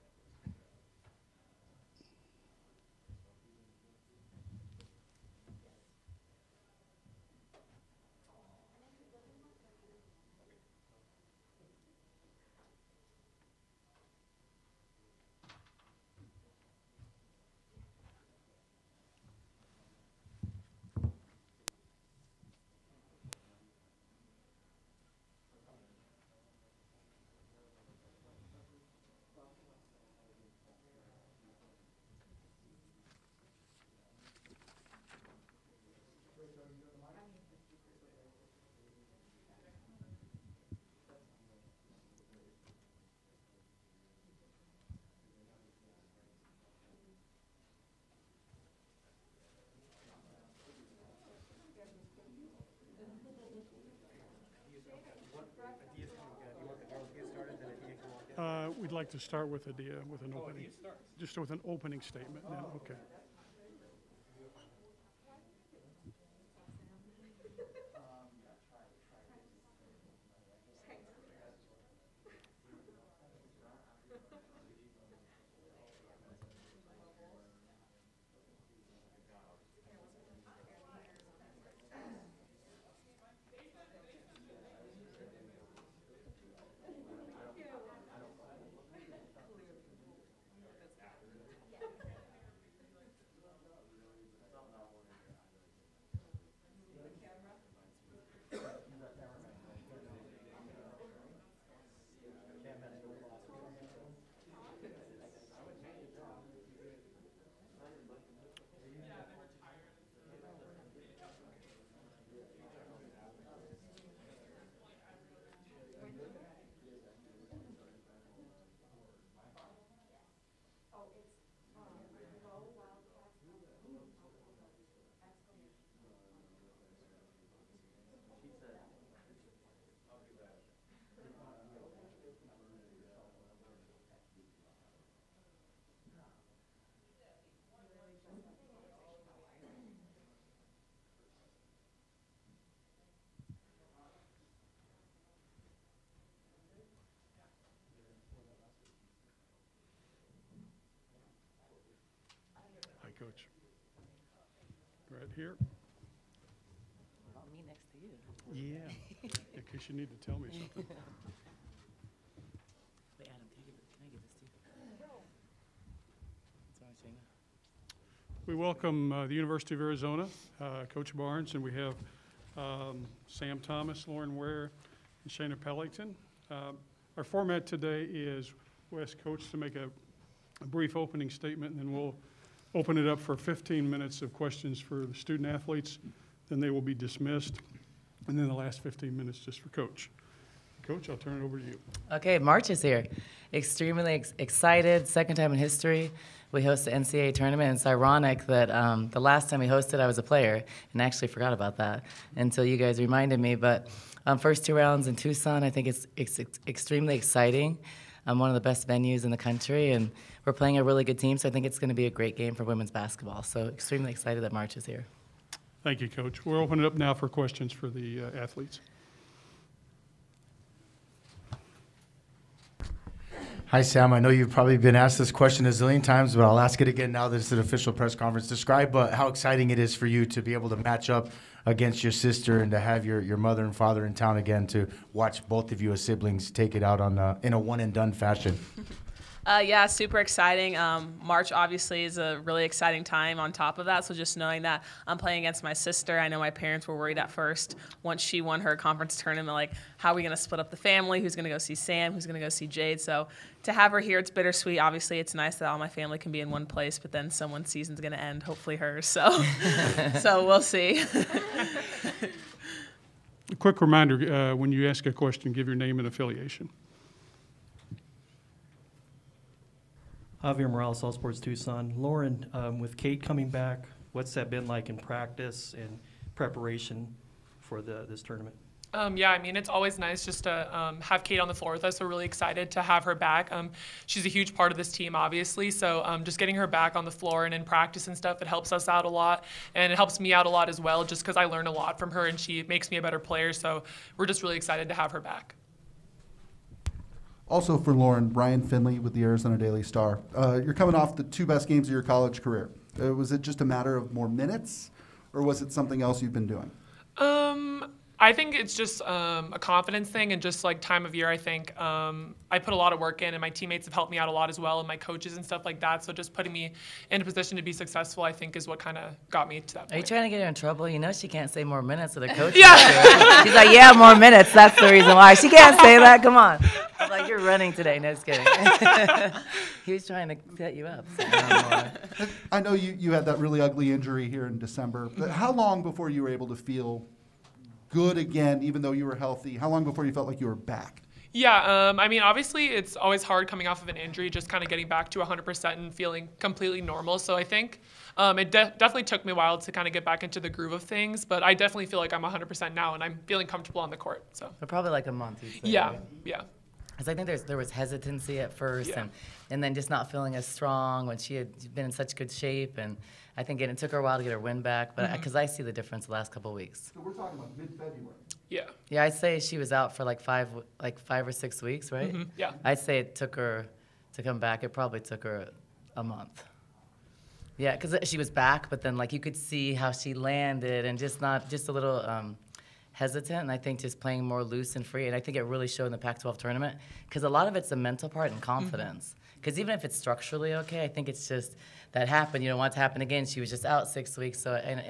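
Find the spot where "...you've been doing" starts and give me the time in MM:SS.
05:06.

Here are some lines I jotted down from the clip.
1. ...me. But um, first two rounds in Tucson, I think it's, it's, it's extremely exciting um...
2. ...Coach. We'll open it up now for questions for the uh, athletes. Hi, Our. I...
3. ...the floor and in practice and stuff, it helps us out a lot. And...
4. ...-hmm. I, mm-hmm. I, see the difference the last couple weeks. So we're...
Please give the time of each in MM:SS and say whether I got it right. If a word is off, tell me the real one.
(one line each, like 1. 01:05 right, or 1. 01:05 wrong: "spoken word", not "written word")
1. 03:23 right
2. 03:36 wrong: "Sam", not "Our"
3. 04:47 right
4. 06:05 right.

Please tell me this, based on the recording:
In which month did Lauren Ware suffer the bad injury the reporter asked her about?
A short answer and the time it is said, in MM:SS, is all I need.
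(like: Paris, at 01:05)
December, at 05:34.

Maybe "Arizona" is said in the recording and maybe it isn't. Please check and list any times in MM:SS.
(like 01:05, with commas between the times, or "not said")
02:49, 04:59.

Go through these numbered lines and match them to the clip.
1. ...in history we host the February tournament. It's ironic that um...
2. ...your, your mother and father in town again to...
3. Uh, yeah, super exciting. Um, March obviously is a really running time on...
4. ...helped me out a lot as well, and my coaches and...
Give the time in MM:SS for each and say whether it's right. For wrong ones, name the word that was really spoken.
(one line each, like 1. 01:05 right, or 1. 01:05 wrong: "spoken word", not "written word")
1. 03:15 wrong: "NCAA", not "February"
2. 03:53 right
3. 03:59 wrong: "exciting", not "running"
4. 05:13 right.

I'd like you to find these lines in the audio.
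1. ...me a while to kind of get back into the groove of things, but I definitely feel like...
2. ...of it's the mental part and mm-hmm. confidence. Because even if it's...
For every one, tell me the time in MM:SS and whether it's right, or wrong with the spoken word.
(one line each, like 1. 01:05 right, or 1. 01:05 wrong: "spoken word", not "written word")
1. 05:49 right
2. 06:27 right.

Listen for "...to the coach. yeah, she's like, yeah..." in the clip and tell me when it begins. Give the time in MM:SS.
05:22.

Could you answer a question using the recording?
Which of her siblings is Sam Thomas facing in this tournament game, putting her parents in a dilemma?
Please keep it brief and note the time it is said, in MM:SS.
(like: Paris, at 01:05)
Jade, at 04:12.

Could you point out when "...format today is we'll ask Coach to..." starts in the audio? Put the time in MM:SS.
02:57.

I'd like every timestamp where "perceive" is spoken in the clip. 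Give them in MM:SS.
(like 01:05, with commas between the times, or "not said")
not said.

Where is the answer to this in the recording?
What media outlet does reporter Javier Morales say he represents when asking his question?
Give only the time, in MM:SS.
04:31.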